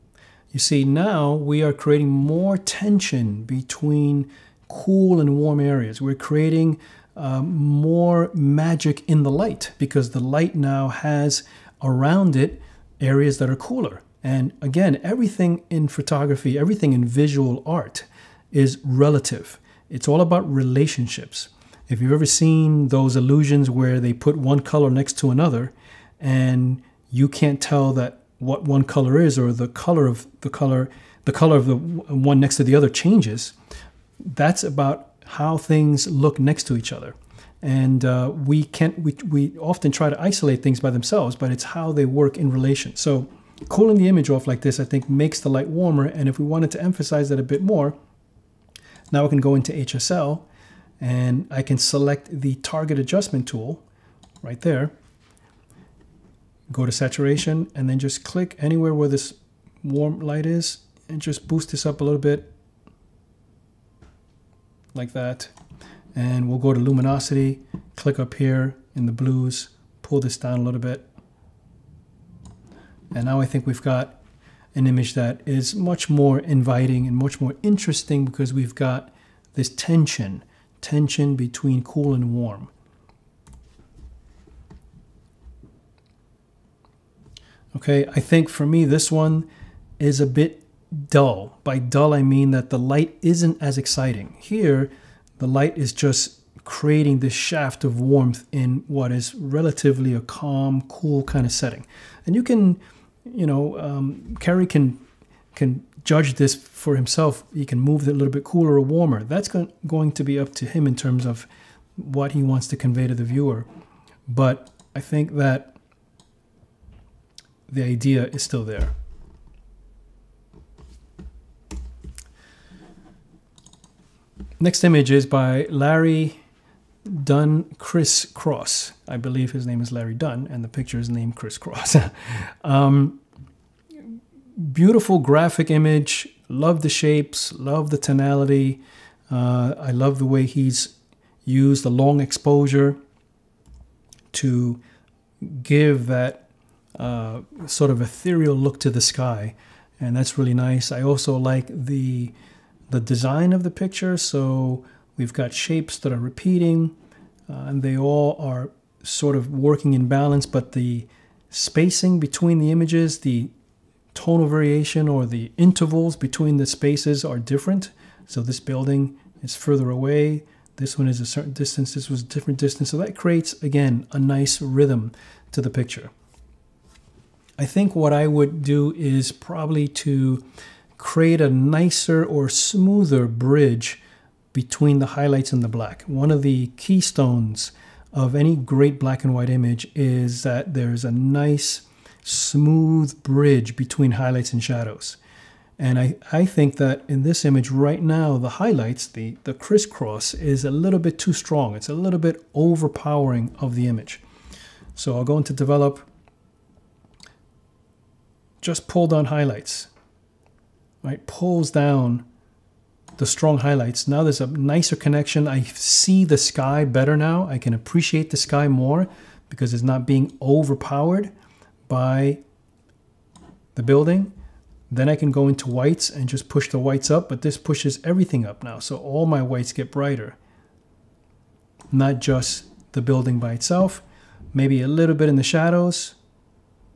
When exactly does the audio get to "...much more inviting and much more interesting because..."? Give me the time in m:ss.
1:15.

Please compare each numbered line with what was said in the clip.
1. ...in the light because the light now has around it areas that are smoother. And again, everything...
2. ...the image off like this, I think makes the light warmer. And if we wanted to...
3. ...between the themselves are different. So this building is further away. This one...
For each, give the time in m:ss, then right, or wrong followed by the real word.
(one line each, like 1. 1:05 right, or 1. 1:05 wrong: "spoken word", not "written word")
1. 0:09 wrong: "cooler", not "smoother"
2. 0:43 right
3. 2:46 wrong: "spaces", not "themselves".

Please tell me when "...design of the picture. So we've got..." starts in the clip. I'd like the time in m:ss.
2:33.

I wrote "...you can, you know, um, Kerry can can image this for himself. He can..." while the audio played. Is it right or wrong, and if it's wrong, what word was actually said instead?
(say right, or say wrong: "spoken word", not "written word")
wrong: "judge", not "image".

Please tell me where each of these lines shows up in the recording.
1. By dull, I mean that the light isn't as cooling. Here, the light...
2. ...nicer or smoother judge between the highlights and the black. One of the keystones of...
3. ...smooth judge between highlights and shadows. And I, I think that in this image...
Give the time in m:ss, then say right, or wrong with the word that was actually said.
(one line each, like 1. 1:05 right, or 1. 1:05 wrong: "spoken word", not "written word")
1. 1:31 wrong: "exciting", not "cooling"
2. 3:01 wrong: "bridge", not "judge"
3. 3:12 wrong: "bridge", not "judge".